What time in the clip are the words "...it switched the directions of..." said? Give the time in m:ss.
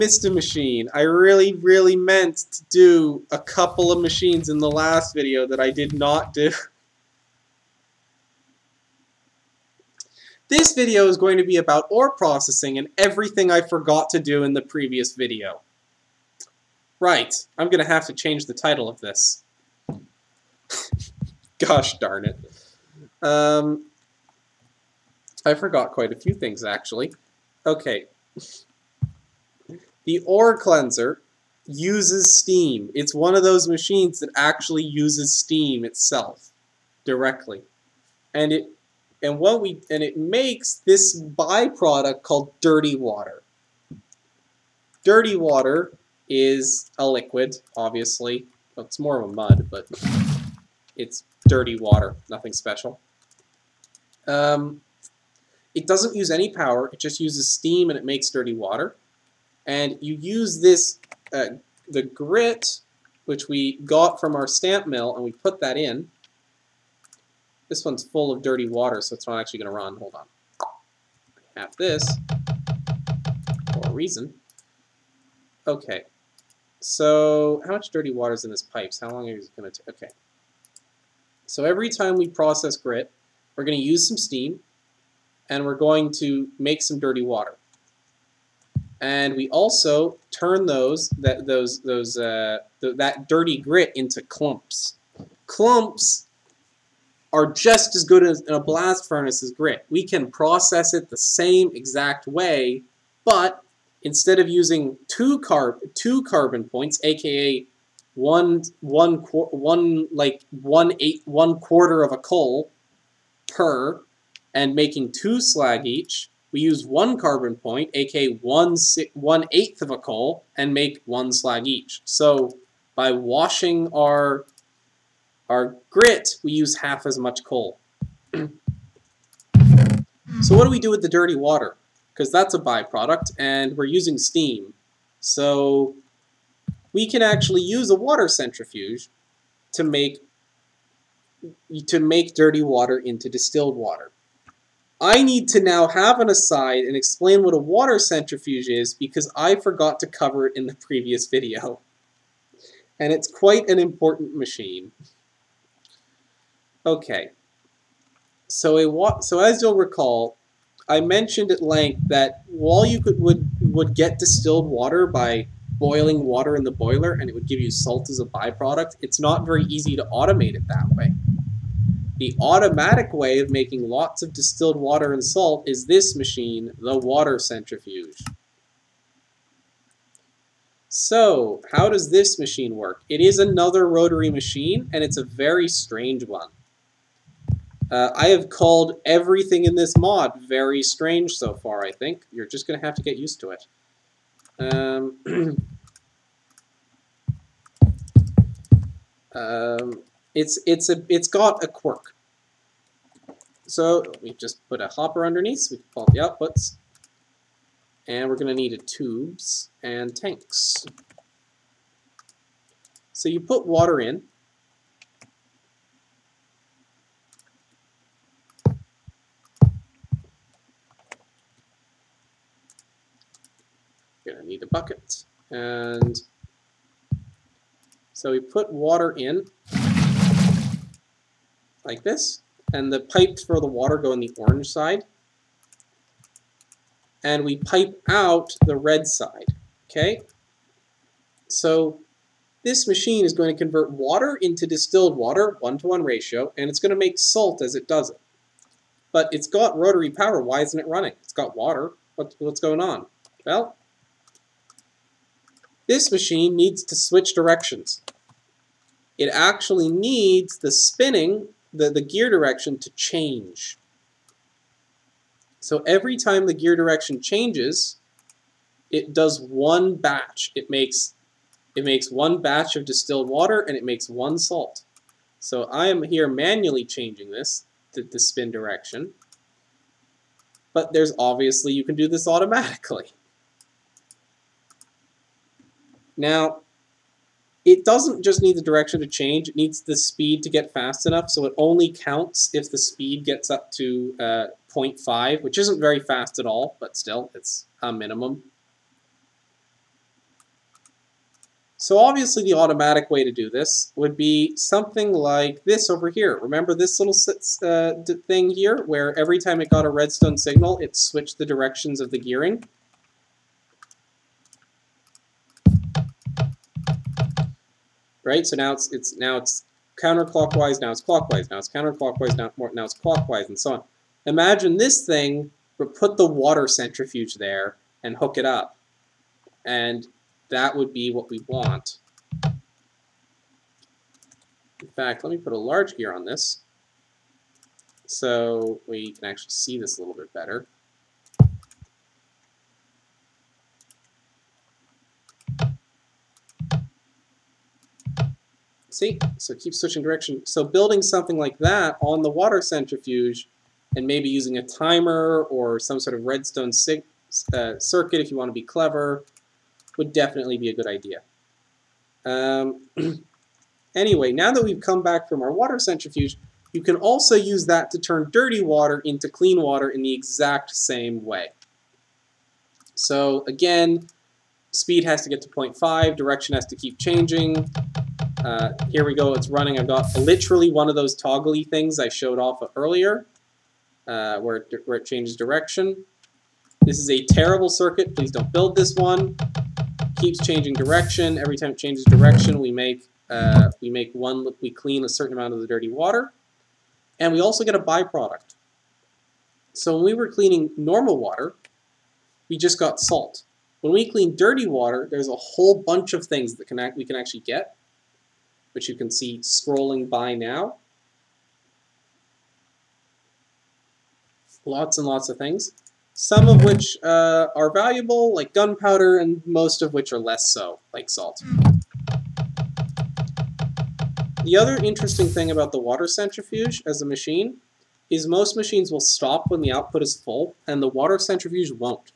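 5:10.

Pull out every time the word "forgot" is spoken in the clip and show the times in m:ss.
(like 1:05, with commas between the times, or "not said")
0:13, 0:25, 2:29.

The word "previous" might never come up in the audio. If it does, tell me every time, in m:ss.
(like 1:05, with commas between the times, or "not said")
0:14, 2:30.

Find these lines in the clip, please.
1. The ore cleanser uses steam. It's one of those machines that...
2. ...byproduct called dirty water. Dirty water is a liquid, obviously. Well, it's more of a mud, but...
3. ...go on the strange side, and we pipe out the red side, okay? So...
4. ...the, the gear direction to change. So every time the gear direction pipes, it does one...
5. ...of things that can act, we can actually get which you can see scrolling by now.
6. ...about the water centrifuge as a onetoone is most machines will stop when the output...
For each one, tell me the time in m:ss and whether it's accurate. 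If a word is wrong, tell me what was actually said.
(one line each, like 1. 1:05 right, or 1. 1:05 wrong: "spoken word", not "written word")
1. 0:30 right
2. 0:41 right
3. 3:53 wrong: "orange", not "strange"
4. 4:21 wrong: "changes", not "pipes"
5. 6:46 right
6. 7:05 wrong: "machine", not "onetoone".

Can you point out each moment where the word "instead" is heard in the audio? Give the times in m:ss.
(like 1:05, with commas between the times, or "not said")
1:44.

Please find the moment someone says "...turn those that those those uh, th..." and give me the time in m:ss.
1:30.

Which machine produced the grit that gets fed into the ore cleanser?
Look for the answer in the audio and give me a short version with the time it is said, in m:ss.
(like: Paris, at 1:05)
stamp mill, at 1:04.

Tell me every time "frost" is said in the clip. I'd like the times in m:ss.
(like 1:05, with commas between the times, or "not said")
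not said.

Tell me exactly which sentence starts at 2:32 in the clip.
And it's quite an important machine.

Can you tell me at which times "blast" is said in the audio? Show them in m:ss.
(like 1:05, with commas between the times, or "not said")
1:38.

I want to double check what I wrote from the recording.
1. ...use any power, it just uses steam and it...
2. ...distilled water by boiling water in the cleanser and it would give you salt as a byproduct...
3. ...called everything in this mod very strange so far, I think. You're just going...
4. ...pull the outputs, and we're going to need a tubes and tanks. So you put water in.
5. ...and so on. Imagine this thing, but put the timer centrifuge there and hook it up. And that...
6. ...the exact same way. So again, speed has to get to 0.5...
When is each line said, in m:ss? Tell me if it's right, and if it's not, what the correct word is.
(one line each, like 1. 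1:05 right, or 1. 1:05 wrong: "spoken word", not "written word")
1. 0:56 right
2. 2:44 wrong: "boiler", not "cleanser"
3. 3:08 right
4. 3:25 right
5. 5:23 wrong: "water", not "timer"
6. 6:10 right.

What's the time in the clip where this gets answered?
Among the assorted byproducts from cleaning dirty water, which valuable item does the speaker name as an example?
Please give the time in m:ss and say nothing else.
6:58.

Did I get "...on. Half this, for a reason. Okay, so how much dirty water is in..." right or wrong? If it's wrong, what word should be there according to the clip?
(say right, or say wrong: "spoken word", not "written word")
right.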